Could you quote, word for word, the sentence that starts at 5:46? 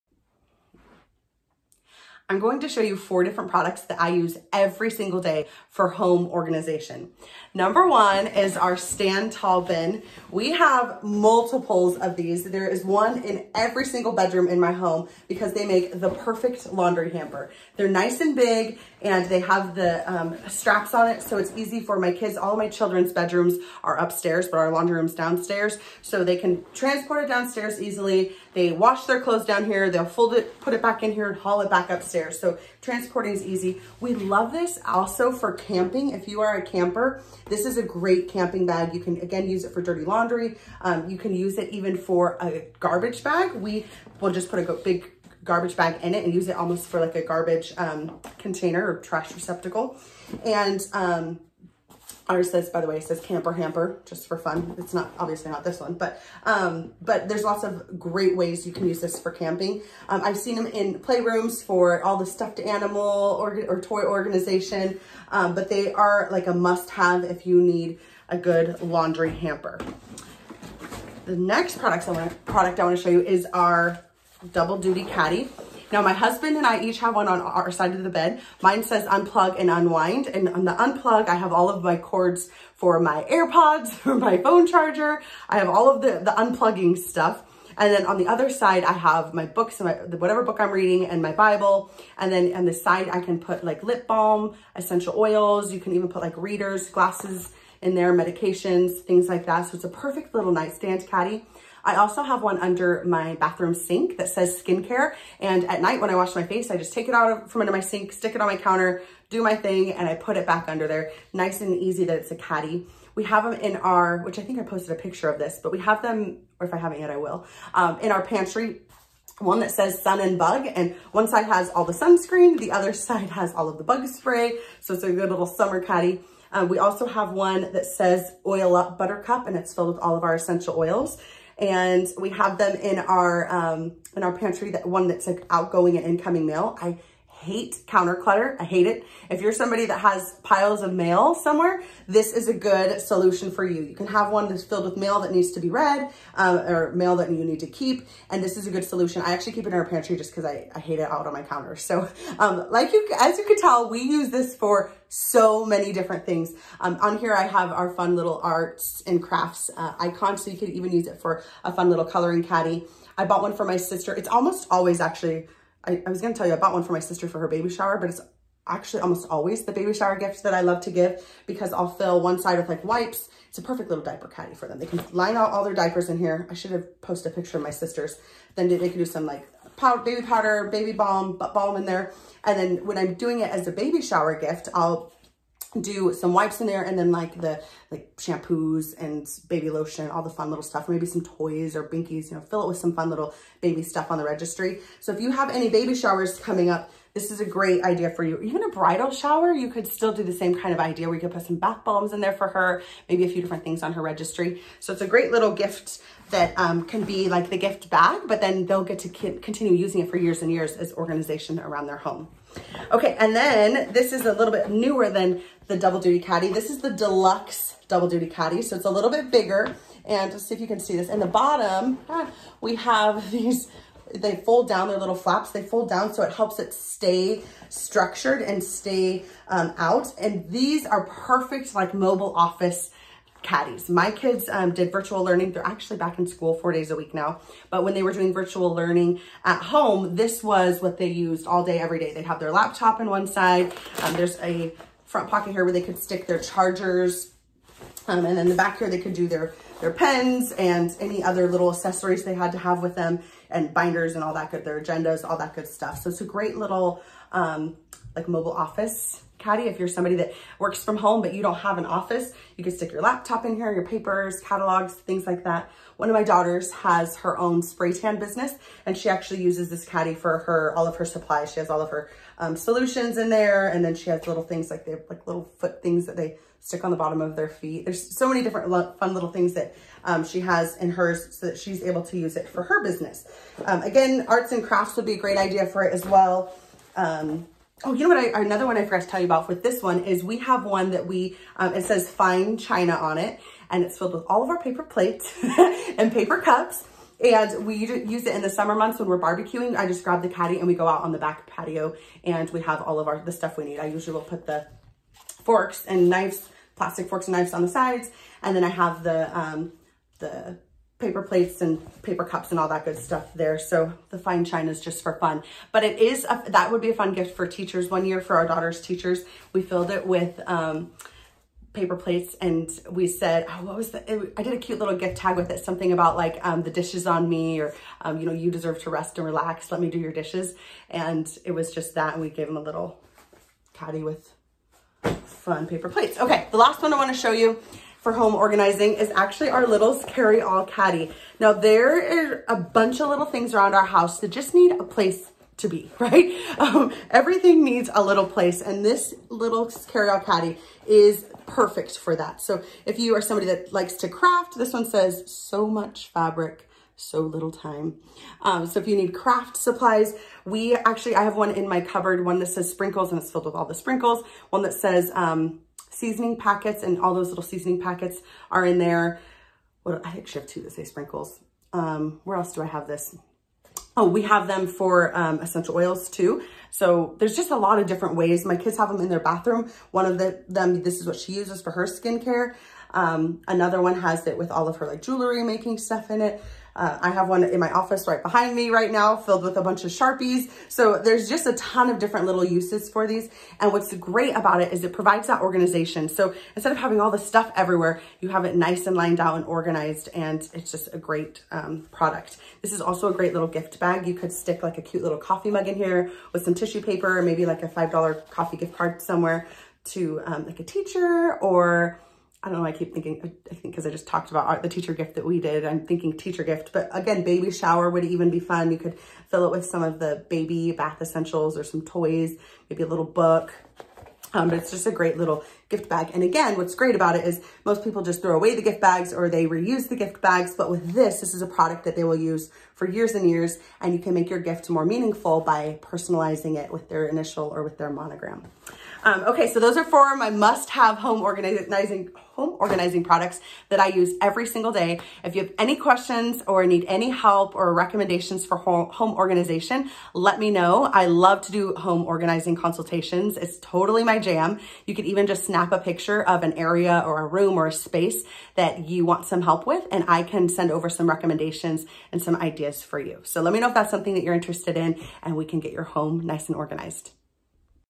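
Um, everything needs a little place and this little carry-all caddy is perfect for that.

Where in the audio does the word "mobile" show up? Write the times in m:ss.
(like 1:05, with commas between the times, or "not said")
3:51, 4:18.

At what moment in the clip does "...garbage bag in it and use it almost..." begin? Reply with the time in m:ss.
0:45.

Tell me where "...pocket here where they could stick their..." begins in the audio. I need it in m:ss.
4:05.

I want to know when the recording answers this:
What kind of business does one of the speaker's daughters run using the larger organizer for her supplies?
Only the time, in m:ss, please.
4:27.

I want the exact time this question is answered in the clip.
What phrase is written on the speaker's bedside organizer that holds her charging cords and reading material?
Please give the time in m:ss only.
1:19.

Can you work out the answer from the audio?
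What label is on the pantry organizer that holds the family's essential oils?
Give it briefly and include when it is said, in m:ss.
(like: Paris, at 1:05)
oil up buttercup, at 2:08.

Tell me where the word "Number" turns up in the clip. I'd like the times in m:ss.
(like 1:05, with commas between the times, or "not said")
0:07.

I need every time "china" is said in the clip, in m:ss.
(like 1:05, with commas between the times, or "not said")
4:52, 5:14.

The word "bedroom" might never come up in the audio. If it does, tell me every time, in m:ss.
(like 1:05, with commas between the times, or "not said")
0:14, 0:23.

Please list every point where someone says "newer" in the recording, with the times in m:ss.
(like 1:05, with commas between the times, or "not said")
3:34.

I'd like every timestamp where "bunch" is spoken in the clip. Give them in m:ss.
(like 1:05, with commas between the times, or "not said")
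5:42, 6:29.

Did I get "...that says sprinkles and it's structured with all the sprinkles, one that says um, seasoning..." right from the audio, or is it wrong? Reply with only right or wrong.
wrong.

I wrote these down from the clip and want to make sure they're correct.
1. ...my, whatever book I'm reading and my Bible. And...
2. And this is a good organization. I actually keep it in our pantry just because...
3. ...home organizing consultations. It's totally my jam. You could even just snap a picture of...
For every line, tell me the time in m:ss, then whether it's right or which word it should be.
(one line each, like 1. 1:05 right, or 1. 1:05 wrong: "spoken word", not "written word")
1. 1:29 right
2. 2:28 wrong: "solution", not "organization"
3. 7:31 right.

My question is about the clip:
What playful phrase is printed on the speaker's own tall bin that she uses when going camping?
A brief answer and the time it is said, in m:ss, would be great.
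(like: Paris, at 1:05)
camper hamper, at 0:53.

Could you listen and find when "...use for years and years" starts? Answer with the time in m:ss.
7:12.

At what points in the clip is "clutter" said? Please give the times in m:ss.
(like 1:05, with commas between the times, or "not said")
2:18.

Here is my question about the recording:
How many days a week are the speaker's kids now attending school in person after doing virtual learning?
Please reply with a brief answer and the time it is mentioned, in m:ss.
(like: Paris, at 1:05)
4, at 3:56.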